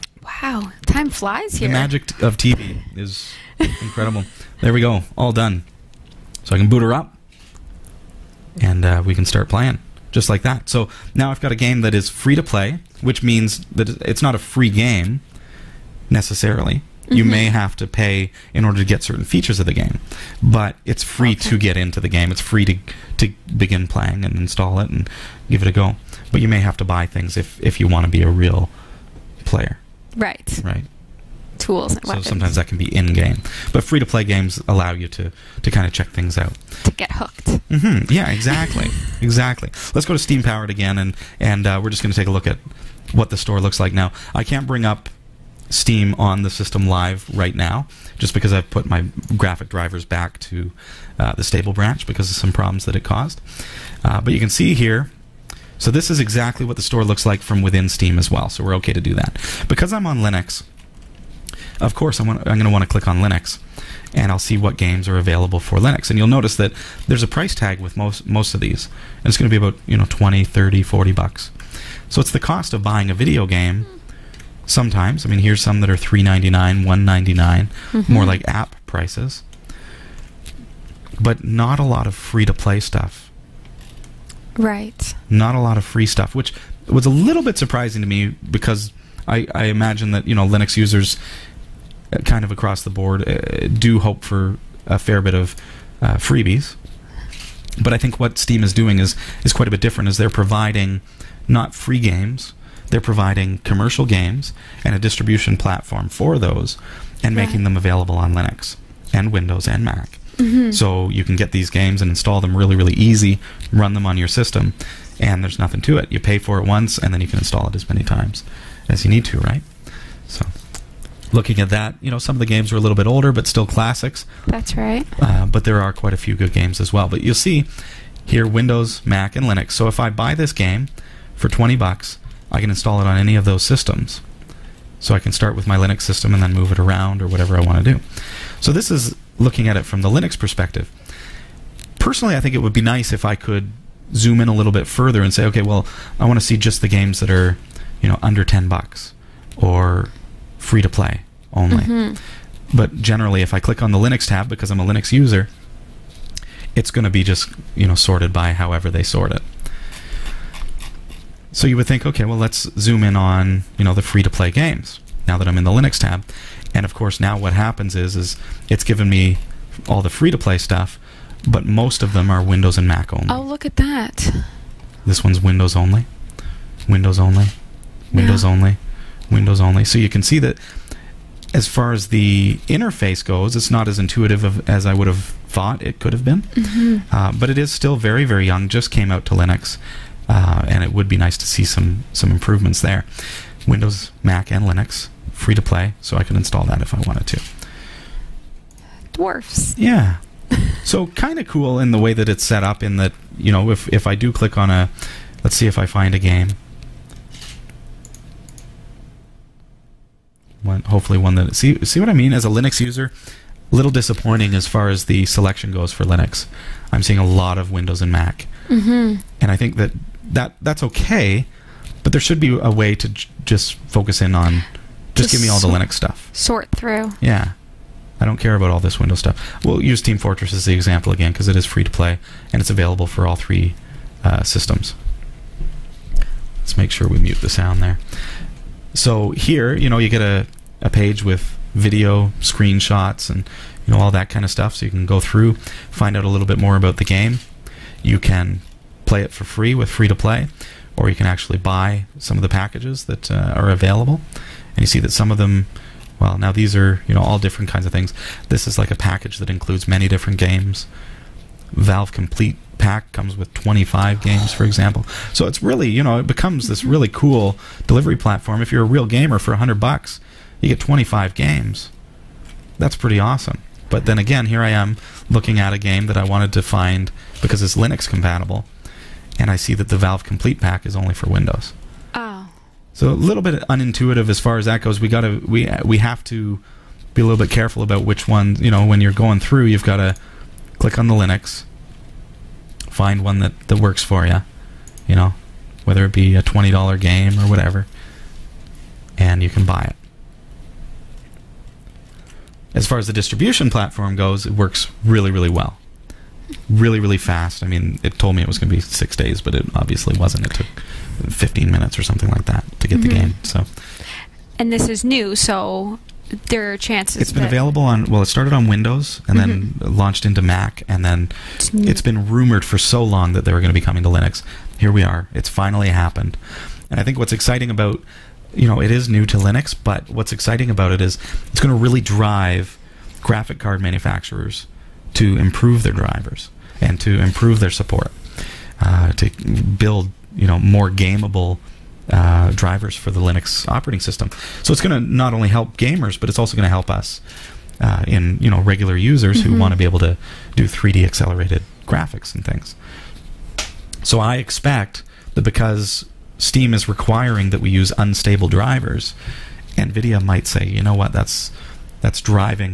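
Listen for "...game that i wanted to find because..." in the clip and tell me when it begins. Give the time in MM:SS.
04:35.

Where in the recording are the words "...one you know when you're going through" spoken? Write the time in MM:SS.
04:48.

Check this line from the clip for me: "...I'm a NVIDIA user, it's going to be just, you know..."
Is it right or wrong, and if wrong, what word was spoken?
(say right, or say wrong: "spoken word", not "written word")
wrong: "Linux", not "NVIDIA".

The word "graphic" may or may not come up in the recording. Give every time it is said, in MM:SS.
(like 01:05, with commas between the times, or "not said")
00:49, 05:33, 05:51.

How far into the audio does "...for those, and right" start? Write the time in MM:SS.
01:46.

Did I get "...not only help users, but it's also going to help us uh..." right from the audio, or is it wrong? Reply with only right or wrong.
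wrong.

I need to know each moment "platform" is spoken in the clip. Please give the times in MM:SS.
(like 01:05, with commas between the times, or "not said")
01:45, 04:28, 05:03.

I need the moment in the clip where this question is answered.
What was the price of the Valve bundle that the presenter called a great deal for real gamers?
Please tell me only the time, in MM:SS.
04:29.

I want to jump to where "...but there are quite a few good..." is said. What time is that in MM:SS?
02:05.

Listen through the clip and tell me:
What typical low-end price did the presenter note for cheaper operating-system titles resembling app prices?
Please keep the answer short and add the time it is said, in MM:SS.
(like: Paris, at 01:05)
$1.99, at 01:16.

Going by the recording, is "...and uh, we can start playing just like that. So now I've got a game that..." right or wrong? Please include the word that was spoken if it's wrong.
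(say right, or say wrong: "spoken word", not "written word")
right.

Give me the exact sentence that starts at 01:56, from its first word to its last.
You pay for it once, and then you can install it as many times as you need to, right?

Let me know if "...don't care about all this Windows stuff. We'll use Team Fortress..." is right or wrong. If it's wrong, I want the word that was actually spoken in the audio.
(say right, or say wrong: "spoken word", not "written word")
right.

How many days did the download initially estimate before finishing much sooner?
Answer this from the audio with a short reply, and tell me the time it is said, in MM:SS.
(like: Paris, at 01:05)
6, at 05:08.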